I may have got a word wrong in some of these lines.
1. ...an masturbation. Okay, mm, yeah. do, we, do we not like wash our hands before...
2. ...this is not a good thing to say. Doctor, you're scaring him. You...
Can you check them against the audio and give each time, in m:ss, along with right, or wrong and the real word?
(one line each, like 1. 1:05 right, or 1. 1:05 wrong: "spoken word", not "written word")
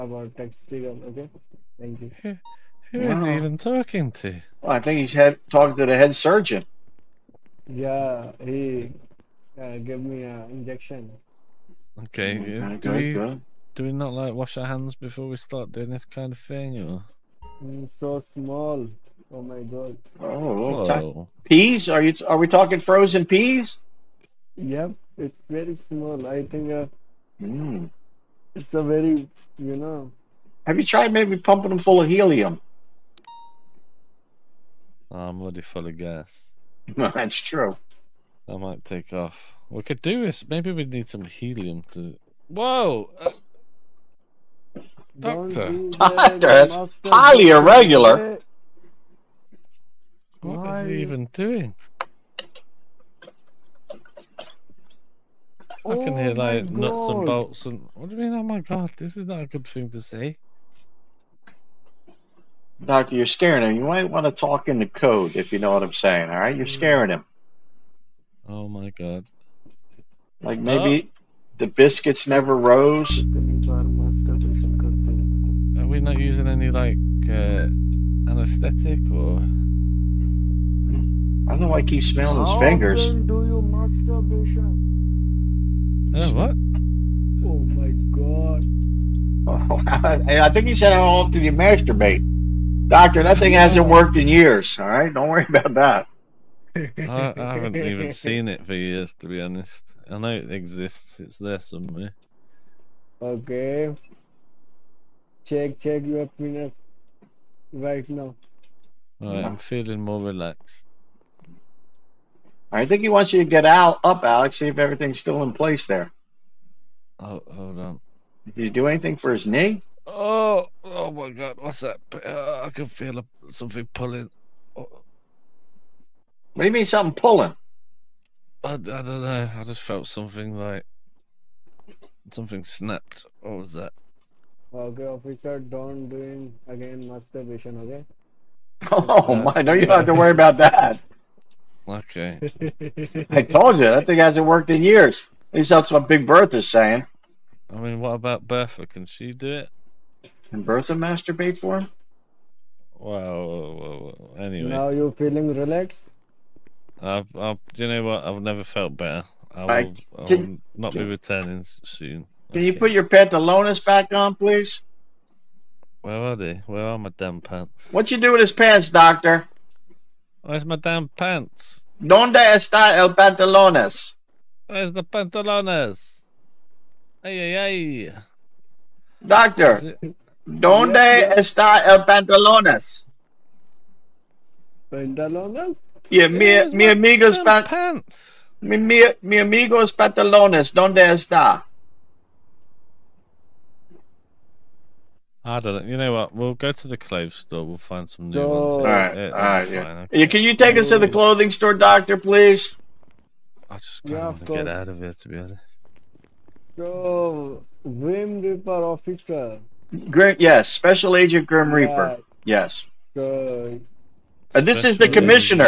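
1. 0:10 wrong: "injection", not "masturbation"
2. 0:58 right.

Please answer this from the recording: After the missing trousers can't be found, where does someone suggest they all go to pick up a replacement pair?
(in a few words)
clothes store.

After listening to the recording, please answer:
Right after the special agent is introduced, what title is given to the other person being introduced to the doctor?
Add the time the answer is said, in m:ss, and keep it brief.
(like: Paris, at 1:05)
commissioner, at 3:35.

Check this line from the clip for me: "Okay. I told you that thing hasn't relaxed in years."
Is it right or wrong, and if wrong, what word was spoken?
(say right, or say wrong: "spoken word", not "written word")
wrong: "worked", not "relaxed".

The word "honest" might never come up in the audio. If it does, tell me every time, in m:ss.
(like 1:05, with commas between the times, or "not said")
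1:39, 3:25.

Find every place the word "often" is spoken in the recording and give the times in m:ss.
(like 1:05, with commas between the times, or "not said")
1:23, 1:31.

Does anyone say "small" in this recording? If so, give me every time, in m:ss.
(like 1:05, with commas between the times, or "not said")
0:18, 0:25.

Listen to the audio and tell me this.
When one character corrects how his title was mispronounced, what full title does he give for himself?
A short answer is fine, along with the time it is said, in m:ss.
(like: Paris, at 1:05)
Special Agent Grim Reaper, at 3:30.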